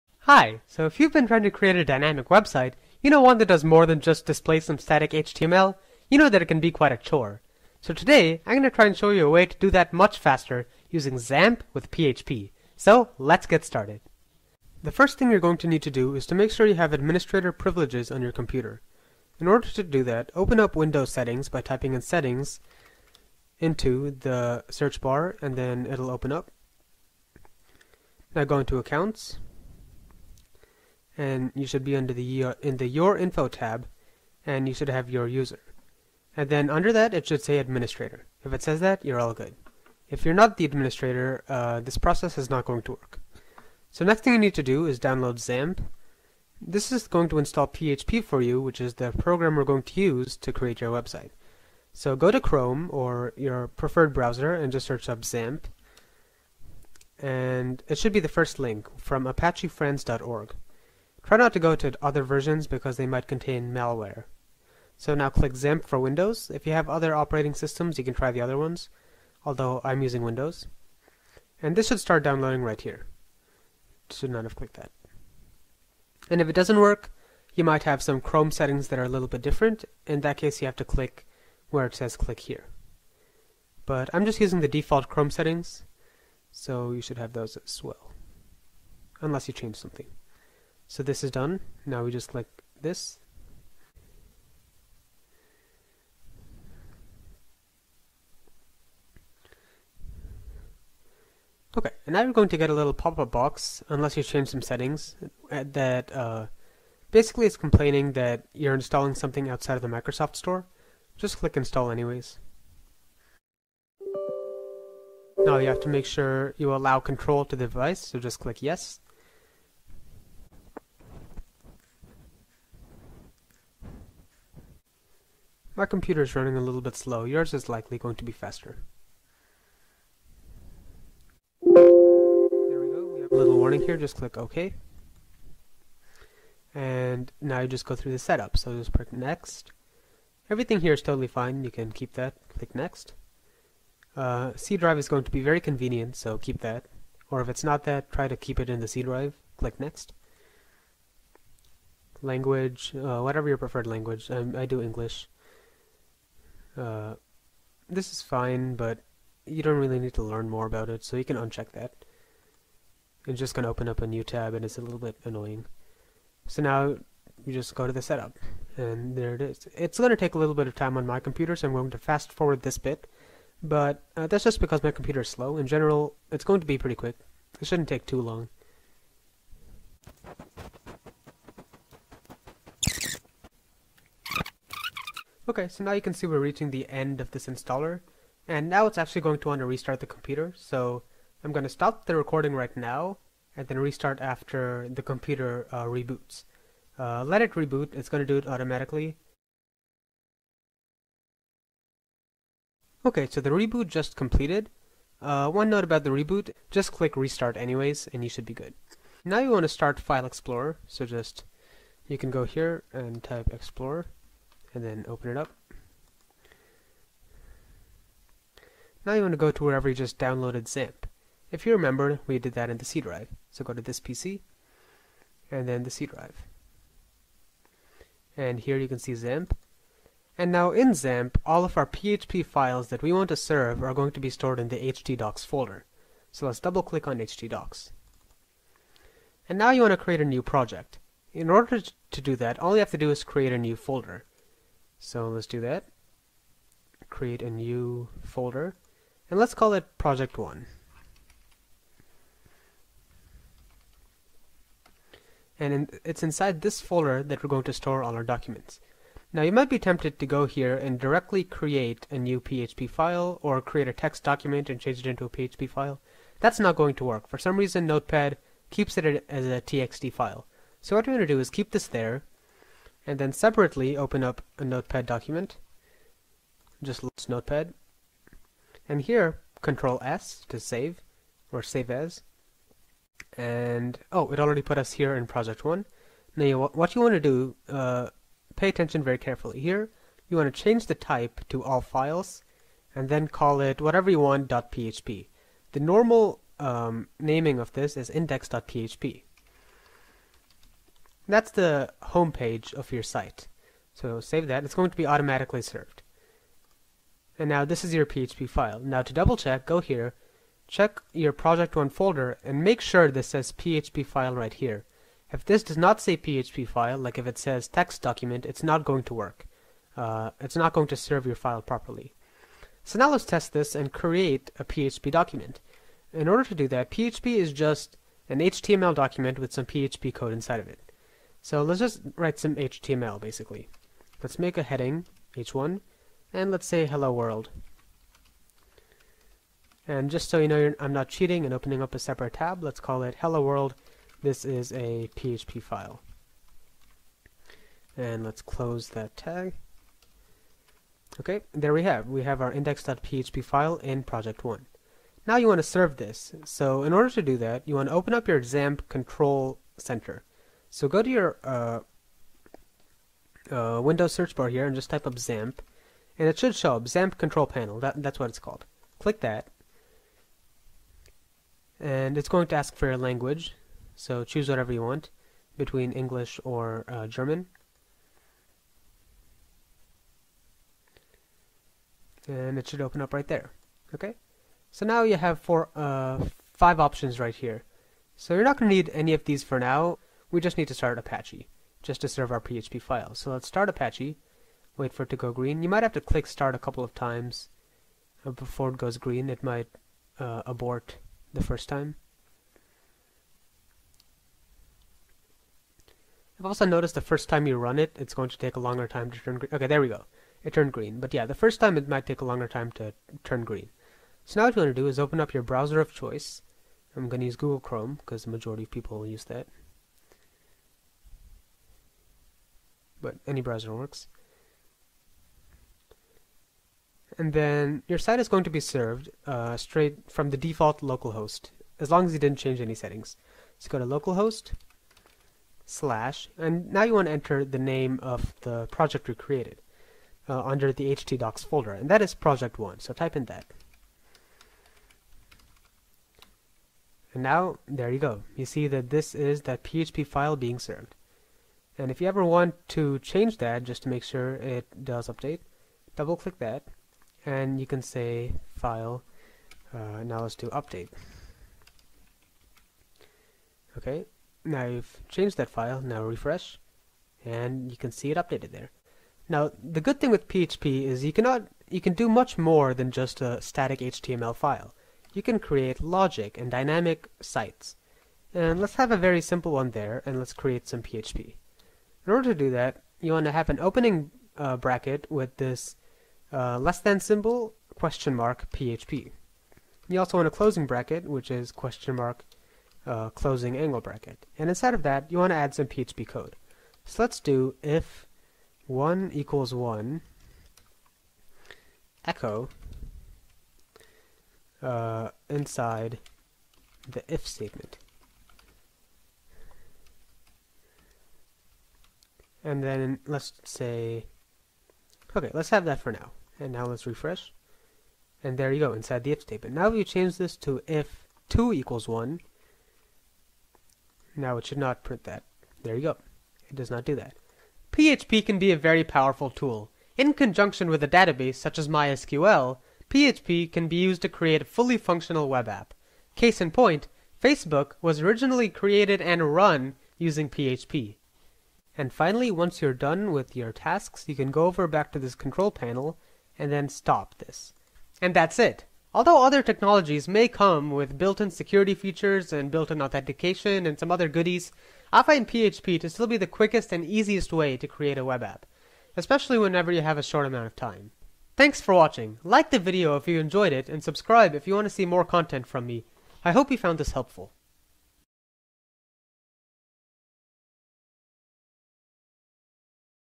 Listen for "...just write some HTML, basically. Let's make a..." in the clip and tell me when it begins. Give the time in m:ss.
5:31.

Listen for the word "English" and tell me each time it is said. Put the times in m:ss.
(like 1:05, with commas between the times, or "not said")
2:34, 6:15.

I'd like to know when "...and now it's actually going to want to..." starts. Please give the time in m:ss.
3:08.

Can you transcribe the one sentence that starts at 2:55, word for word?
In general, it's going to be pretty quick.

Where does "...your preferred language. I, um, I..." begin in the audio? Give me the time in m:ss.
2:33.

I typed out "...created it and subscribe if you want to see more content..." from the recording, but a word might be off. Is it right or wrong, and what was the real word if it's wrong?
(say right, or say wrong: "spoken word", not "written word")
wrong: "enjoyed", not "created".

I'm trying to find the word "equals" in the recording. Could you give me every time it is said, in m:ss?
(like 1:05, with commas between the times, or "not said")
8:19, 8:41.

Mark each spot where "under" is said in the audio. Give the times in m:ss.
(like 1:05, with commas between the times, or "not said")
0:31, 0:36, 7:20.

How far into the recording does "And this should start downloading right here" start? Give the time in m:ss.
1:11.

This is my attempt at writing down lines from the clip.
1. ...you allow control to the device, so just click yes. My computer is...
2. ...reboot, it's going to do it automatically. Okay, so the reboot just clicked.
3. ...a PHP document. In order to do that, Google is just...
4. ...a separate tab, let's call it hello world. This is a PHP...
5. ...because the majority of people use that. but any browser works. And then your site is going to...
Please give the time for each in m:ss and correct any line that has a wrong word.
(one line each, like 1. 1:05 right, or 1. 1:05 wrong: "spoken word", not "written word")
1. 1:56 right
2. 3:17 wrong: "completed", not "clicked"
3. 5:24 wrong: "PHP", not "Google"
4. 5:41 right
5. 6:57 right.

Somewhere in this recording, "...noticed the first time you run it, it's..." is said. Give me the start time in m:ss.
6:46.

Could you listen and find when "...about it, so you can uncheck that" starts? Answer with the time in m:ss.
2:40.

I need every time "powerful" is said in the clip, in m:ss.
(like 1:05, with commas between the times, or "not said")
8:48.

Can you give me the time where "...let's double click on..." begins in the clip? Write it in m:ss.
3:56.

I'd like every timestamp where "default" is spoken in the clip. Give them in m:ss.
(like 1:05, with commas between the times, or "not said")
1:24, 7:10.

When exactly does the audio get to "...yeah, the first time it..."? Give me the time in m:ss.
6:51.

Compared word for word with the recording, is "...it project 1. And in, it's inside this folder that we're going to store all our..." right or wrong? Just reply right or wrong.
right.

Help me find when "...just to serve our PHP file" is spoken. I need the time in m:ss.
6:31.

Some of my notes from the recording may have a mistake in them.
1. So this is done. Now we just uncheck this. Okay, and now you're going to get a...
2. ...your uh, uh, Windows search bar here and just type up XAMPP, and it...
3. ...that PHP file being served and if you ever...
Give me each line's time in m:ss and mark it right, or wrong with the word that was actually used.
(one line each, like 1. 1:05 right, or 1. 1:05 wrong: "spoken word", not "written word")
1. 1:30 wrong: "click", not "uncheck"
2. 6:01 right
3. 7:29 right.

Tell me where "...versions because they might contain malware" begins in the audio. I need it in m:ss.
1:02.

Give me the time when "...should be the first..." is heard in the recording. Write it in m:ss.
0:57.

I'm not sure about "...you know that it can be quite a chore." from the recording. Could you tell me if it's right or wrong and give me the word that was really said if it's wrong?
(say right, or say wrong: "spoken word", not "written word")
right.